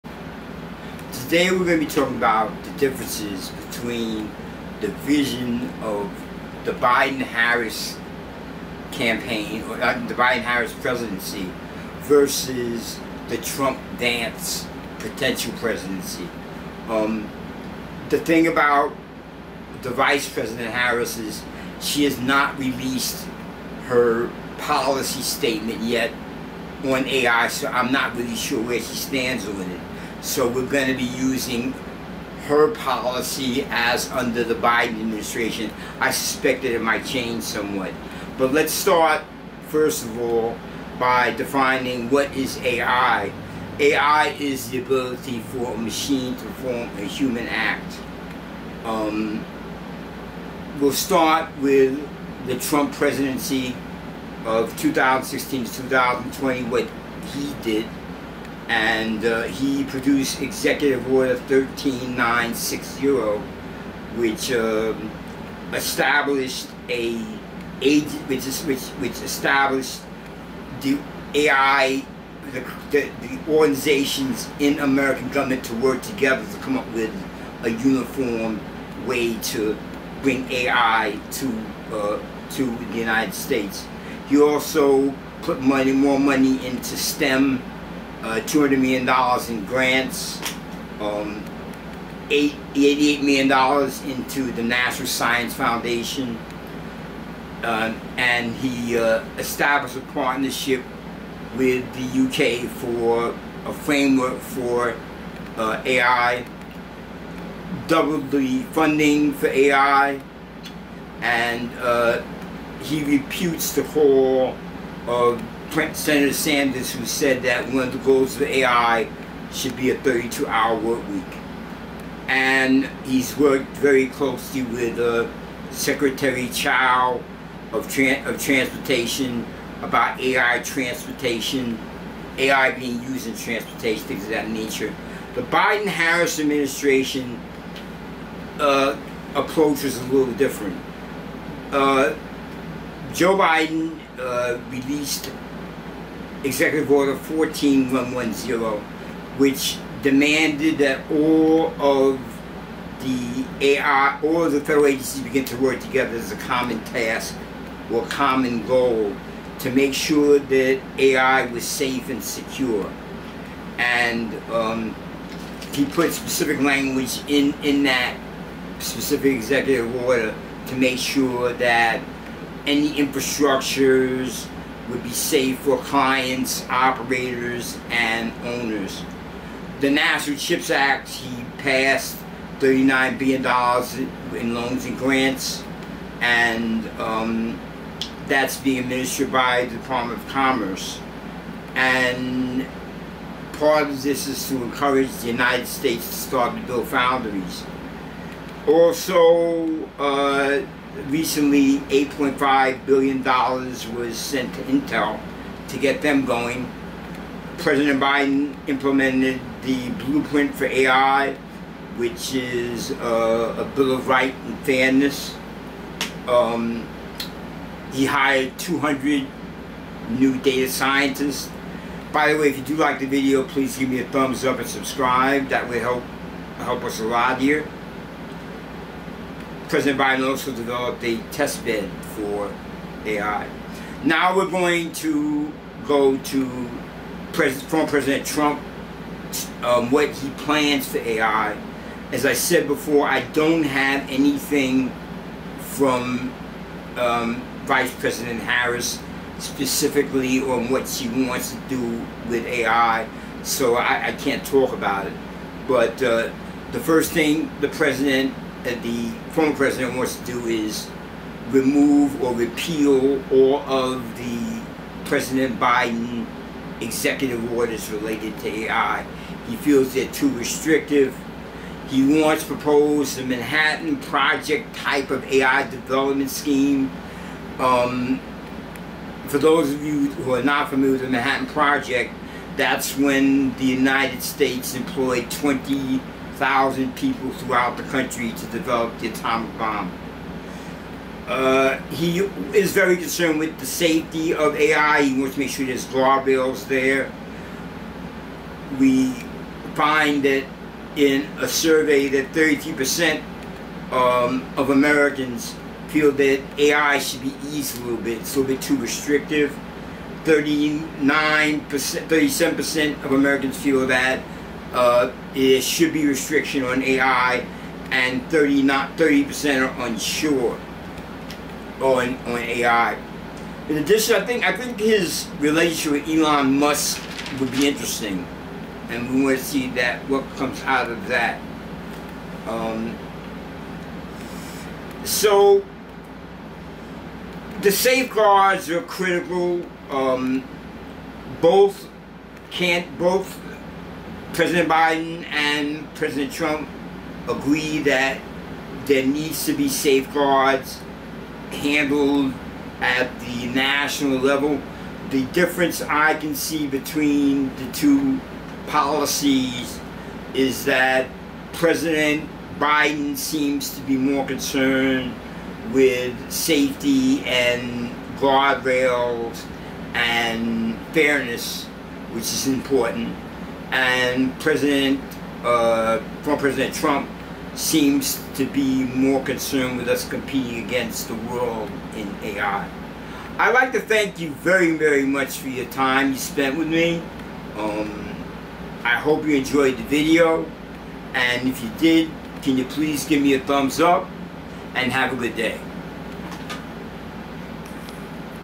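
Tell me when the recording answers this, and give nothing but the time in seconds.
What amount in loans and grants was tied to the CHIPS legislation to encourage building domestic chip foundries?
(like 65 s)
182 s.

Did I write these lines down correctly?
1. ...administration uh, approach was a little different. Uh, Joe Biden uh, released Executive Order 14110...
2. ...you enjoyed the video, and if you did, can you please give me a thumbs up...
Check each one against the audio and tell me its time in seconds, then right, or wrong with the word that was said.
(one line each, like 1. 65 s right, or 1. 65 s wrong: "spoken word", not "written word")
1. 136 s right
2. 389 s right.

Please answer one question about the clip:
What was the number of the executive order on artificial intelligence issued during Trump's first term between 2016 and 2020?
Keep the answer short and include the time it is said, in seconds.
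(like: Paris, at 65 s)
13960, at 60 s.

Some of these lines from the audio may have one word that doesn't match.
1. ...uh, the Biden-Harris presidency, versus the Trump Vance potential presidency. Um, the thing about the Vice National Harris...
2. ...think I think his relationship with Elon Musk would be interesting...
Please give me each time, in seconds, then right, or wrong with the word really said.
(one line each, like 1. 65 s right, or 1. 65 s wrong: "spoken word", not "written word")
1. 9 s wrong: "President", not "National"
2. 324 s right.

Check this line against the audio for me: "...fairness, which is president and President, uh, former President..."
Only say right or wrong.
wrong.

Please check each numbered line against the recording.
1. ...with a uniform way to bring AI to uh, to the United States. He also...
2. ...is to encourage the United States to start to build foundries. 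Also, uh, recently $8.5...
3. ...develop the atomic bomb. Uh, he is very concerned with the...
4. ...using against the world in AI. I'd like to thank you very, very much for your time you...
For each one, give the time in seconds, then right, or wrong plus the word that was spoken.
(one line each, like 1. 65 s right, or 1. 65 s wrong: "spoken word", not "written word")
1. 76 s right
2. 194 s right
3. 288 s right
4. 380 s wrong: "competing", not "using".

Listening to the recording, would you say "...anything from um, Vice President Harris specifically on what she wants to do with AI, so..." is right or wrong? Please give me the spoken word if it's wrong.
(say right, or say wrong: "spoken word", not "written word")
right.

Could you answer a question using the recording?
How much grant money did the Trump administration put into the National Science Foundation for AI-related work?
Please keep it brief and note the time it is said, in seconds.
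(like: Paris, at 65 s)
$88 million, at 92 s.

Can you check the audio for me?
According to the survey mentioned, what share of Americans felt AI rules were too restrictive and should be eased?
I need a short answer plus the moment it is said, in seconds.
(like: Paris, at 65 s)
33%, at 302 s.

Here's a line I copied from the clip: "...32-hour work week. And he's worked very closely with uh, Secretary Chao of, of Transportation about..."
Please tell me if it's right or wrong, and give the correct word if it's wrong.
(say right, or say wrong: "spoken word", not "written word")
right.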